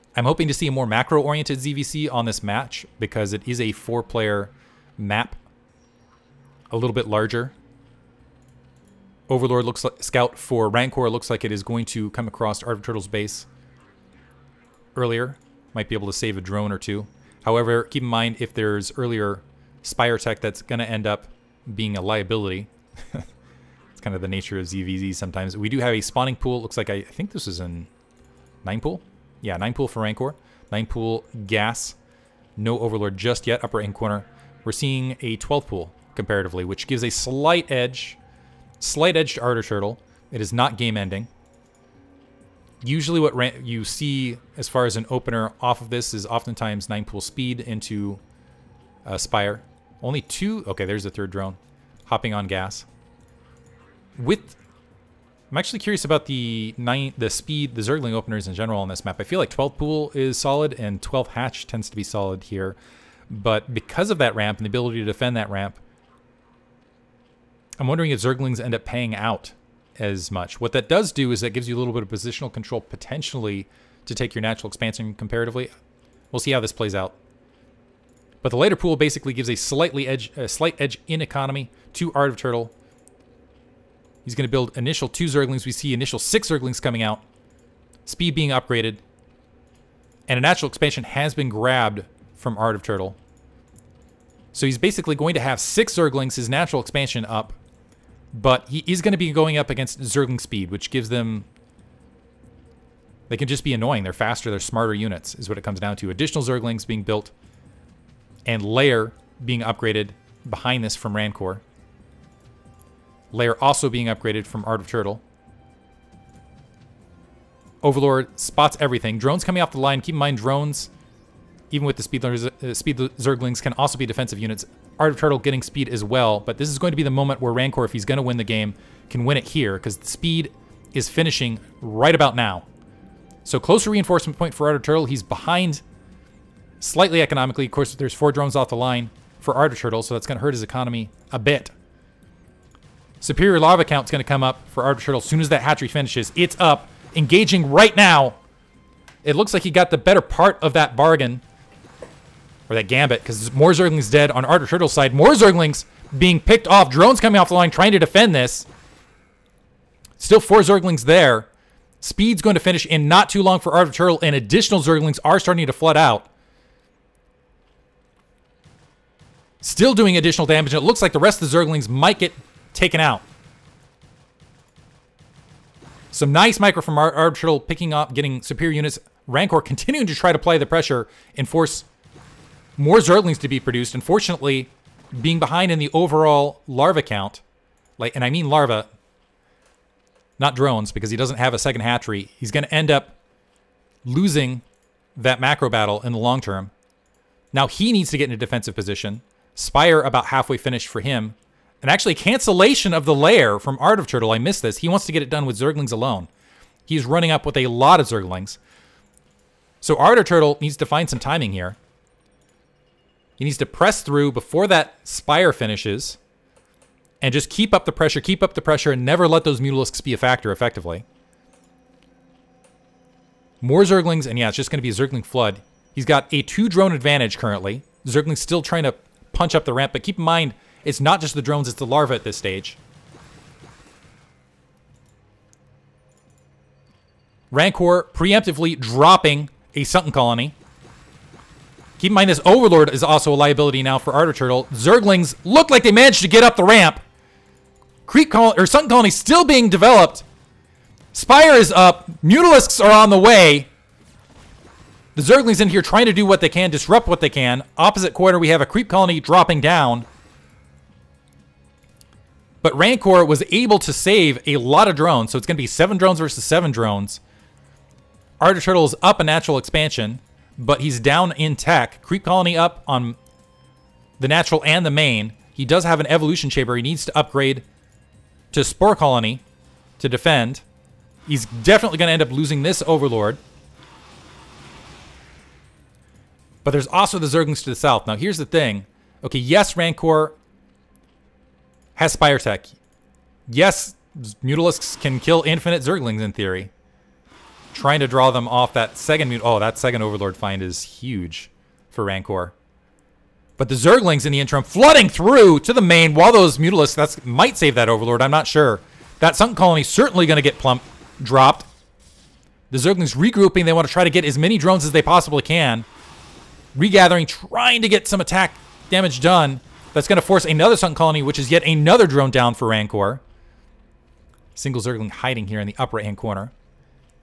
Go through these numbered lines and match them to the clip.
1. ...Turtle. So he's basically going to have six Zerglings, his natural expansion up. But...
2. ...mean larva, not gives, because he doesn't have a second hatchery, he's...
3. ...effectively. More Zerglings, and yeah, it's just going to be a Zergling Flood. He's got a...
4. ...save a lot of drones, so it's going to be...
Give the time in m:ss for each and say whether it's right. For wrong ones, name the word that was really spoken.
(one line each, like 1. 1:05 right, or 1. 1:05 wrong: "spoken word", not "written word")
1. 1:32 right
2. 3:08 wrong: "drones", not "gives"
3. 3:40 right
4. 4:23 right.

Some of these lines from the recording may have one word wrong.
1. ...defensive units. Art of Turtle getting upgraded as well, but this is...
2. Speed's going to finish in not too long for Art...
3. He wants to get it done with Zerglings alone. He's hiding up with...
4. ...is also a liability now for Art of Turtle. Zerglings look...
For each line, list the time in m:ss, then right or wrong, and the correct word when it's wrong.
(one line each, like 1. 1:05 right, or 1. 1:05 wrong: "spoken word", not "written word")
1. 2:04 wrong: "speed", not "upgraded"
2. 2:42 right
3. 3:24 wrong: "running", not "hiding"
4. 4:02 right.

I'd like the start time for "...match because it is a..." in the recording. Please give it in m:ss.
0:02.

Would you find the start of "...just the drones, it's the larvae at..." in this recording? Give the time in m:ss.
3:51.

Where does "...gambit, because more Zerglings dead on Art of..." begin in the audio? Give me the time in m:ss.
2:32.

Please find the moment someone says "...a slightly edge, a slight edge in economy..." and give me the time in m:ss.
1:19.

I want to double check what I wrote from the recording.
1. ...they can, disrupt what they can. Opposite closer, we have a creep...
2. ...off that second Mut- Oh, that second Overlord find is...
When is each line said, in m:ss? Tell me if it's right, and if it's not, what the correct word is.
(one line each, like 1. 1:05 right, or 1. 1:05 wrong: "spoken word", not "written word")
1. 4:16 wrong: "corner", not "closer"
2. 4:58 right.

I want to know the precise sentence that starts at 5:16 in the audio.
Regathering, trying to get some attack damage done.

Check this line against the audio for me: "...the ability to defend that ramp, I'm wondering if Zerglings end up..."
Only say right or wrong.
right.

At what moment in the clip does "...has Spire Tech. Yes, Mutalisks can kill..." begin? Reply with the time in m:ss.
4:51.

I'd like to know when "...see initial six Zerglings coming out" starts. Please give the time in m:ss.
1:25.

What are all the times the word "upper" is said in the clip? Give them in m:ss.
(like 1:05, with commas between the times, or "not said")
0:33, 5:25.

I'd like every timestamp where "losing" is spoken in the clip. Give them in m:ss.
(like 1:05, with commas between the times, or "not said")
3:14, 4:42.